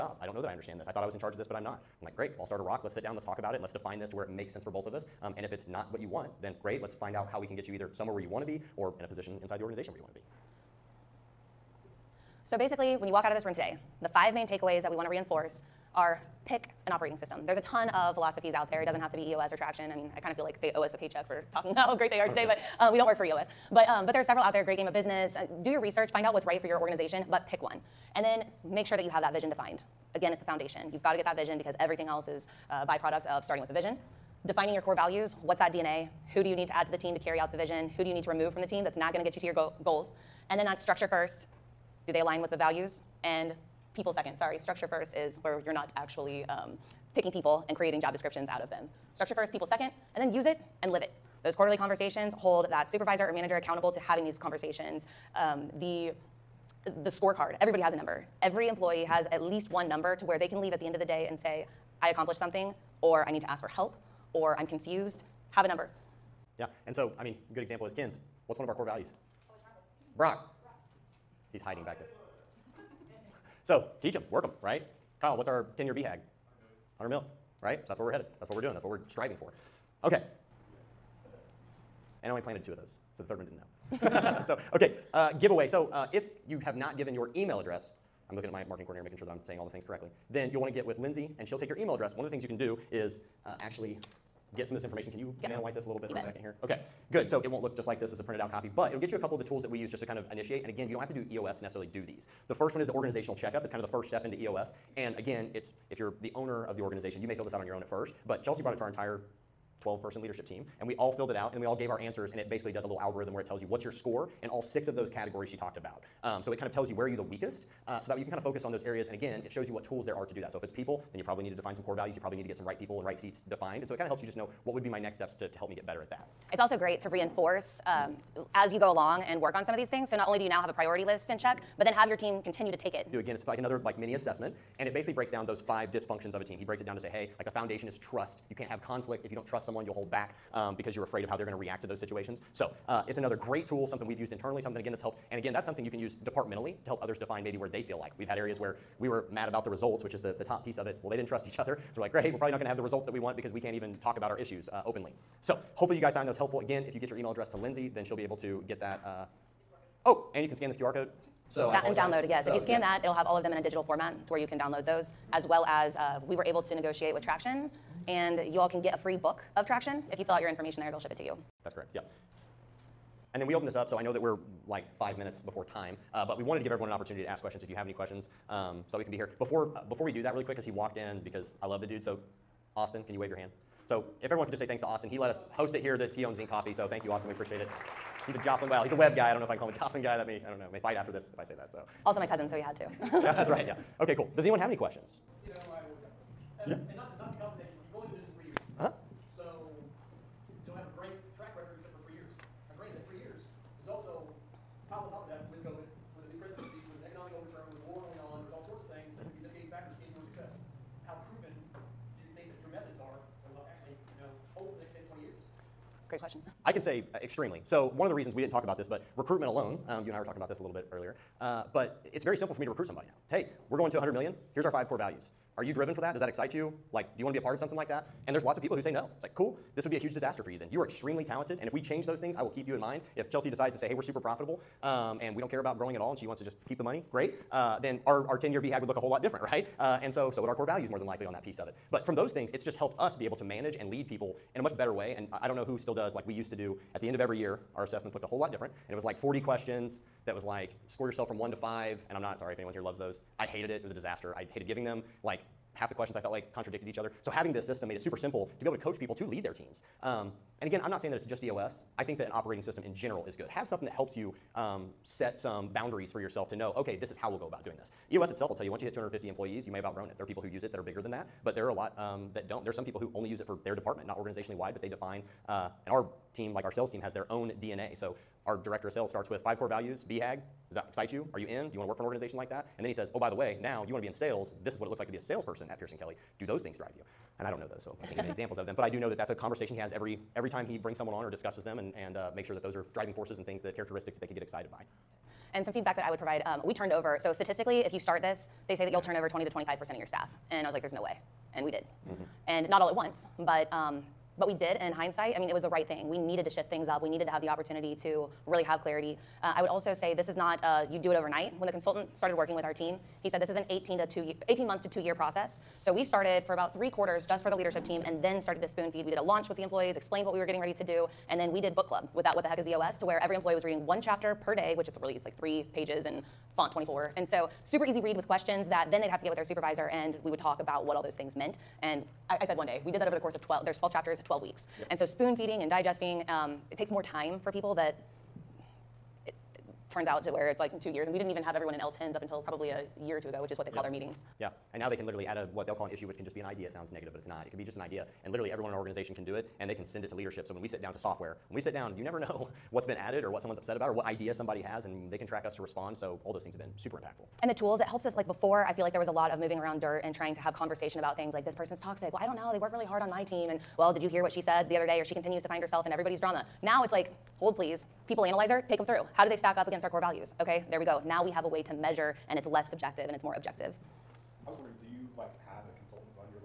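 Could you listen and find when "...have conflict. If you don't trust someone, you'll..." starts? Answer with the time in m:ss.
2:18.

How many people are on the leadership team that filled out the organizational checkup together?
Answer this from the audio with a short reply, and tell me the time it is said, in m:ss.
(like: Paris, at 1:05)
12, at 1:49.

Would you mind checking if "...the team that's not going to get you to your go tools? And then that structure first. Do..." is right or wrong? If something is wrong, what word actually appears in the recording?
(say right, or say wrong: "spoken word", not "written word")
wrong: "goals", not "tools".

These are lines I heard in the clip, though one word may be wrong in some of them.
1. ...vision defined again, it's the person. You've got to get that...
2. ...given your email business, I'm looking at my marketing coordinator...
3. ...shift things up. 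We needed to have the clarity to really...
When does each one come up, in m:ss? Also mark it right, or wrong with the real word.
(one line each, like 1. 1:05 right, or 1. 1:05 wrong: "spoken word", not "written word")
1. 0:29 wrong: "foundation", not "person"
2. 1:26 wrong: "address", not "business"
3. 5:06 wrong: "opportunity", not "clarity".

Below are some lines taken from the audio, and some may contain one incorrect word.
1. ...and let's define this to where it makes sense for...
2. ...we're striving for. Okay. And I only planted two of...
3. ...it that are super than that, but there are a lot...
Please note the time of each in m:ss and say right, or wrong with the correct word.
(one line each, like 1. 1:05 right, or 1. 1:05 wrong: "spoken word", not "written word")
1. 0:03 right
2. 1:18 right
3. 4:30 wrong: "bigger", not "super".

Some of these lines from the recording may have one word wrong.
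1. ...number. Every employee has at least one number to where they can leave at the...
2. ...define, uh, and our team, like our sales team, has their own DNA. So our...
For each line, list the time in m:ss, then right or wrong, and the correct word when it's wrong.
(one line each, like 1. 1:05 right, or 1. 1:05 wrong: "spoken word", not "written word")
1. 0:57 right
2. 4:34 right.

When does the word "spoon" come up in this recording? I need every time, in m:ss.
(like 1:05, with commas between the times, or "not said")
5:18, 5:35.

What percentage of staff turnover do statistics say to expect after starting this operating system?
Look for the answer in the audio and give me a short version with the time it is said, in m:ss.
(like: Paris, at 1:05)
20 to 25 percent, at 4:59.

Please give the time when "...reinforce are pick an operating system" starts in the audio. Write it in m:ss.
0:15.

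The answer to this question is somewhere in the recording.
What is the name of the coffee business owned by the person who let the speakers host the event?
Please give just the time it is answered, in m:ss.
3:06.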